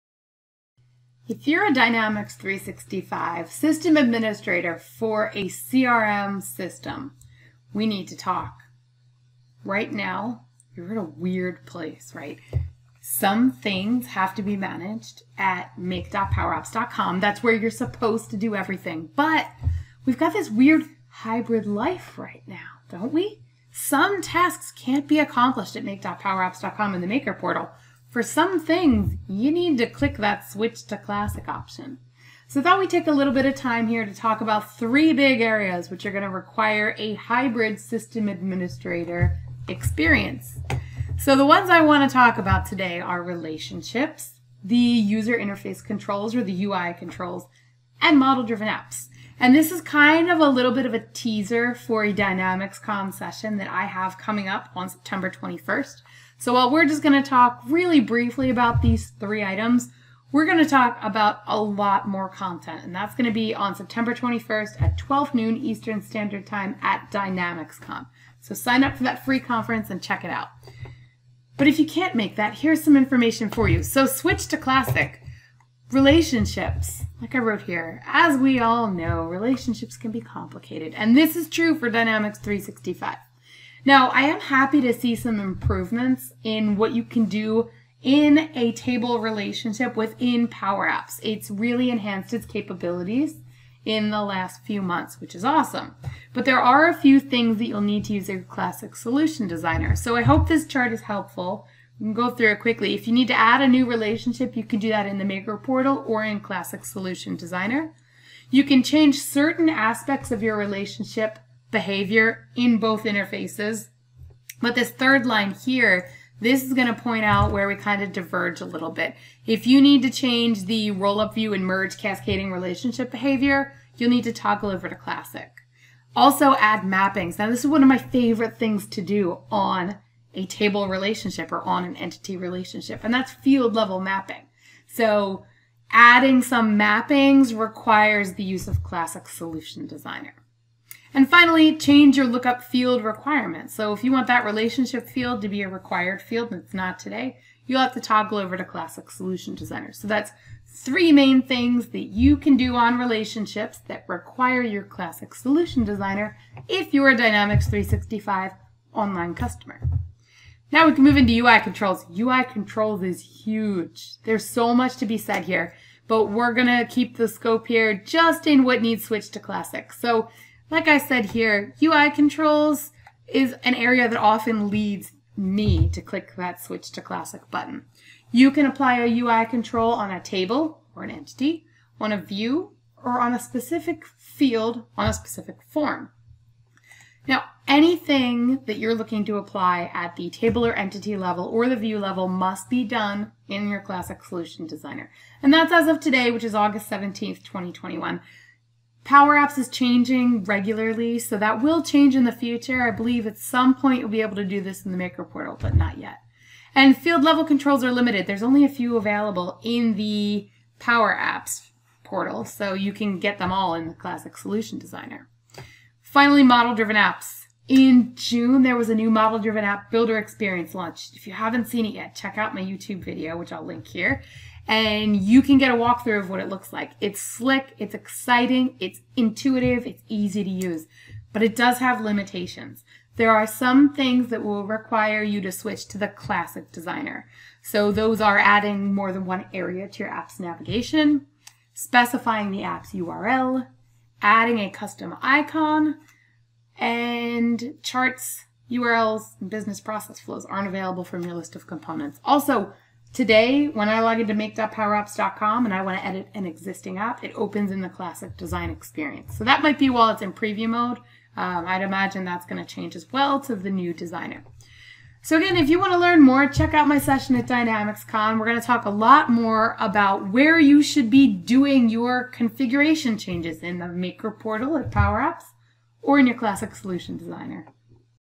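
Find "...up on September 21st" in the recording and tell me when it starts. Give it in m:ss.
0:54.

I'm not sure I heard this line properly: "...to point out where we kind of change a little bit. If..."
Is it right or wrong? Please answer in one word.
wrong.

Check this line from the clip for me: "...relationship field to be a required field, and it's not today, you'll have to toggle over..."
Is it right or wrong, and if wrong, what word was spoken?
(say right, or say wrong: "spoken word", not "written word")
right.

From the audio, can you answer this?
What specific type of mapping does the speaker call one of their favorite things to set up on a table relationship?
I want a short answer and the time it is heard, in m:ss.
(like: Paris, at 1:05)
field level mapping, at 2:13.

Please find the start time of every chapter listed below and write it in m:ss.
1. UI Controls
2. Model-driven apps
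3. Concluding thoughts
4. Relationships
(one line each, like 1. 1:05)
1. 2:40
2. 3:36
3. 4:25
4. 1:16.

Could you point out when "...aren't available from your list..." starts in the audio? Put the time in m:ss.
4:10.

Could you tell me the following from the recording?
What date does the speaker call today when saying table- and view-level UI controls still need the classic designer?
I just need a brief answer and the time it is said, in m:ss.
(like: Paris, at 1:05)
August 17th, 2021, at 3:16.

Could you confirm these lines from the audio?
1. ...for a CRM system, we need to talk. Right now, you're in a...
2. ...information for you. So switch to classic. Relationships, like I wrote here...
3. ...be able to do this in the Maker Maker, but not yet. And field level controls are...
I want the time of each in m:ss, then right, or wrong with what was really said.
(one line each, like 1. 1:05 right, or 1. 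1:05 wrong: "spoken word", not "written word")
1. 0:04 right
2. 1:12 right
3. 3:24 wrong: "Portal", not "Maker".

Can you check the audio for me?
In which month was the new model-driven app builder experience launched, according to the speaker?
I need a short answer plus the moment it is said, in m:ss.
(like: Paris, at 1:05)
June, at 3:38.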